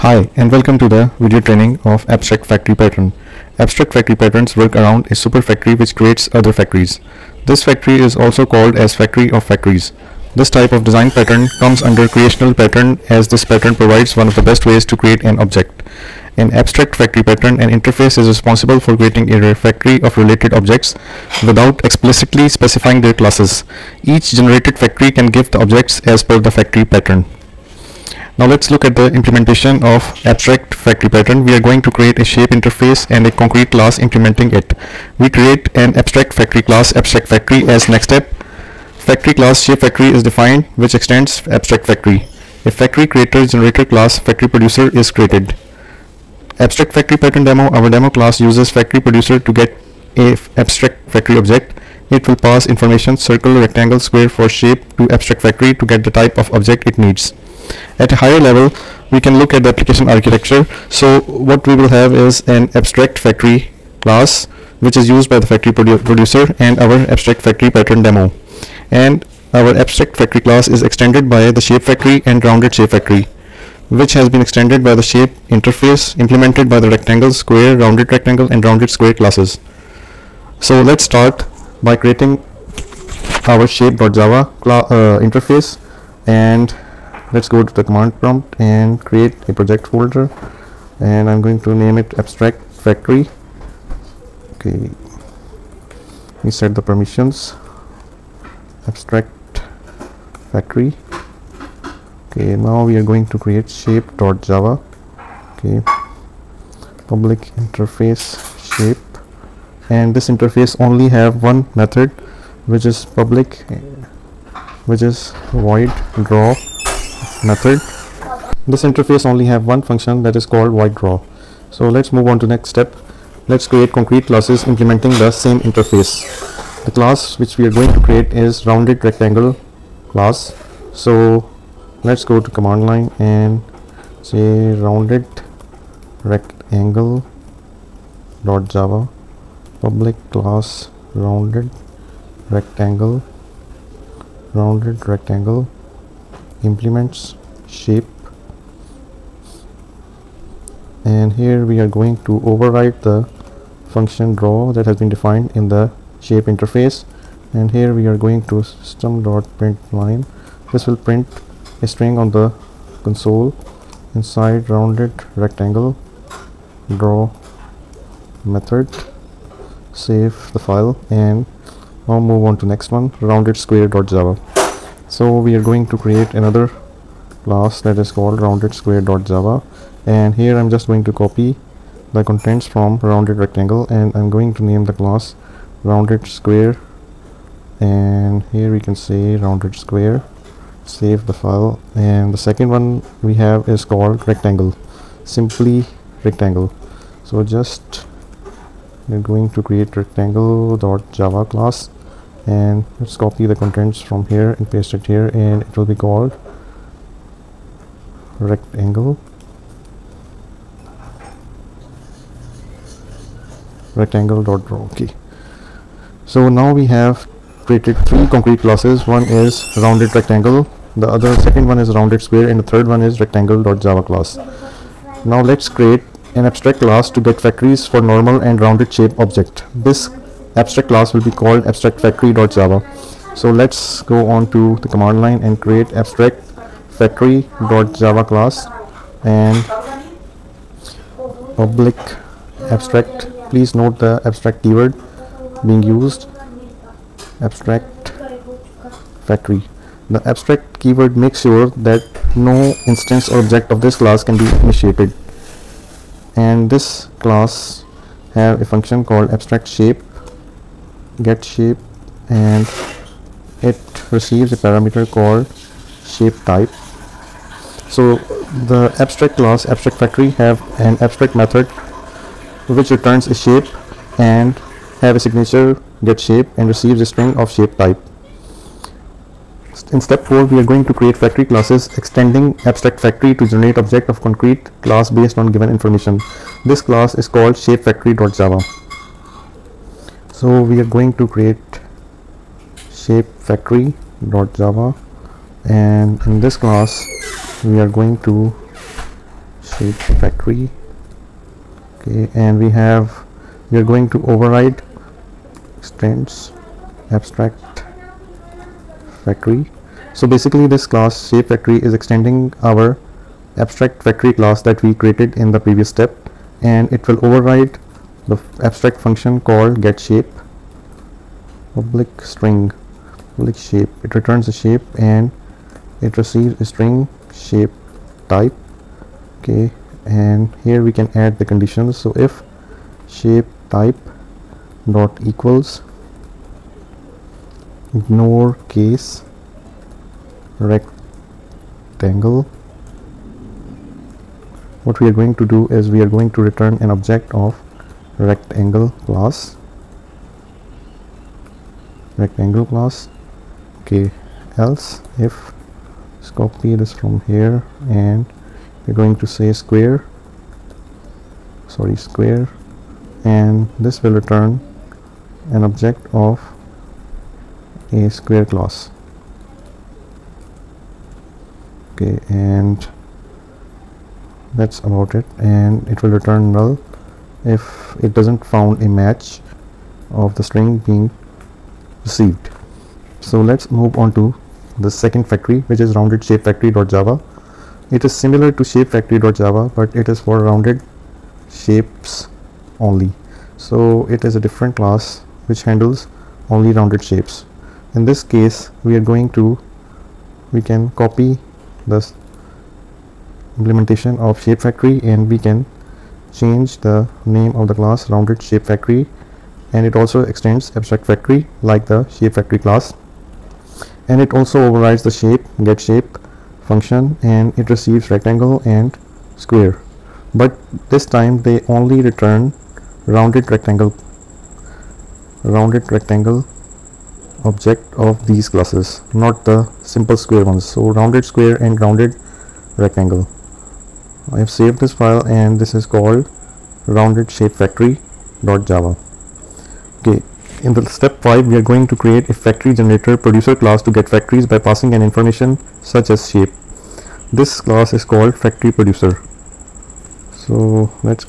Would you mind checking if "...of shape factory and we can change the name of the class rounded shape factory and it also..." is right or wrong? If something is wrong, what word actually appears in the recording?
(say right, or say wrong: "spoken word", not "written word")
right.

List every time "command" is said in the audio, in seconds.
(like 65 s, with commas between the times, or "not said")
87 s, 132 s, 234 s.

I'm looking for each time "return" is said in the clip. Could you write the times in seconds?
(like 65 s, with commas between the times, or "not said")
272 s, 324 s, 346 s, 364 s, 376 s, 422 s.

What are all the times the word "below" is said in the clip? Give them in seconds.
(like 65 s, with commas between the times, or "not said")
not said.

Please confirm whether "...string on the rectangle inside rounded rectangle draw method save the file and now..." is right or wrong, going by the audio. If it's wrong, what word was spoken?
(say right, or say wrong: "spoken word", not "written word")
wrong: "console", not "rectangle".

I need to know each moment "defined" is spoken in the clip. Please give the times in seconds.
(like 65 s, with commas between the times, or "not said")
40 s, 155 s.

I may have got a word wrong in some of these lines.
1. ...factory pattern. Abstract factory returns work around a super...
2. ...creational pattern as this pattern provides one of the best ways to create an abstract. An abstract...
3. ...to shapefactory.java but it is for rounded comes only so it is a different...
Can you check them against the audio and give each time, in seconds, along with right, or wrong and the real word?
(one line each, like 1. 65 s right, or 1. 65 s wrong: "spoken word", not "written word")
1. 2 s wrong: "patterns", not "returns"
2. 12 s wrong: "object", not "abstract"
3. 388 s wrong: "shapes", not "comes".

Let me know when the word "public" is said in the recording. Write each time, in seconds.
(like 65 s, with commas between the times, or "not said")
107 s, 113 s, 139 s, 241 s, 321 s.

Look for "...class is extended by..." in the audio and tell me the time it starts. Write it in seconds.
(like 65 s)
70 s.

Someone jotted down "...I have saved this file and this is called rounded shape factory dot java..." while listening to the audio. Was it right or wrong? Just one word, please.
right.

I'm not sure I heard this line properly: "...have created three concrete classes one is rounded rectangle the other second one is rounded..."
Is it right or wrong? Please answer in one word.
right.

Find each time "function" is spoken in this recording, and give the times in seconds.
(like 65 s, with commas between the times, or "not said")
119 s, 153 s, 258 s, 318 s, 416 s.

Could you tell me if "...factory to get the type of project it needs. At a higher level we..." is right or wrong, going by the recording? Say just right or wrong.
wrong.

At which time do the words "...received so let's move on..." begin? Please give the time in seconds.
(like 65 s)
382 s.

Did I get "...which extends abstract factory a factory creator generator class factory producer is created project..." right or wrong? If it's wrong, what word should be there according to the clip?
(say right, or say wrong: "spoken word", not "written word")
wrong: "abstract", not "project".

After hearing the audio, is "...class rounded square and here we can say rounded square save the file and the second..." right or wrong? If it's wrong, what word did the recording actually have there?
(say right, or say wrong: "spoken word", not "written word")
right.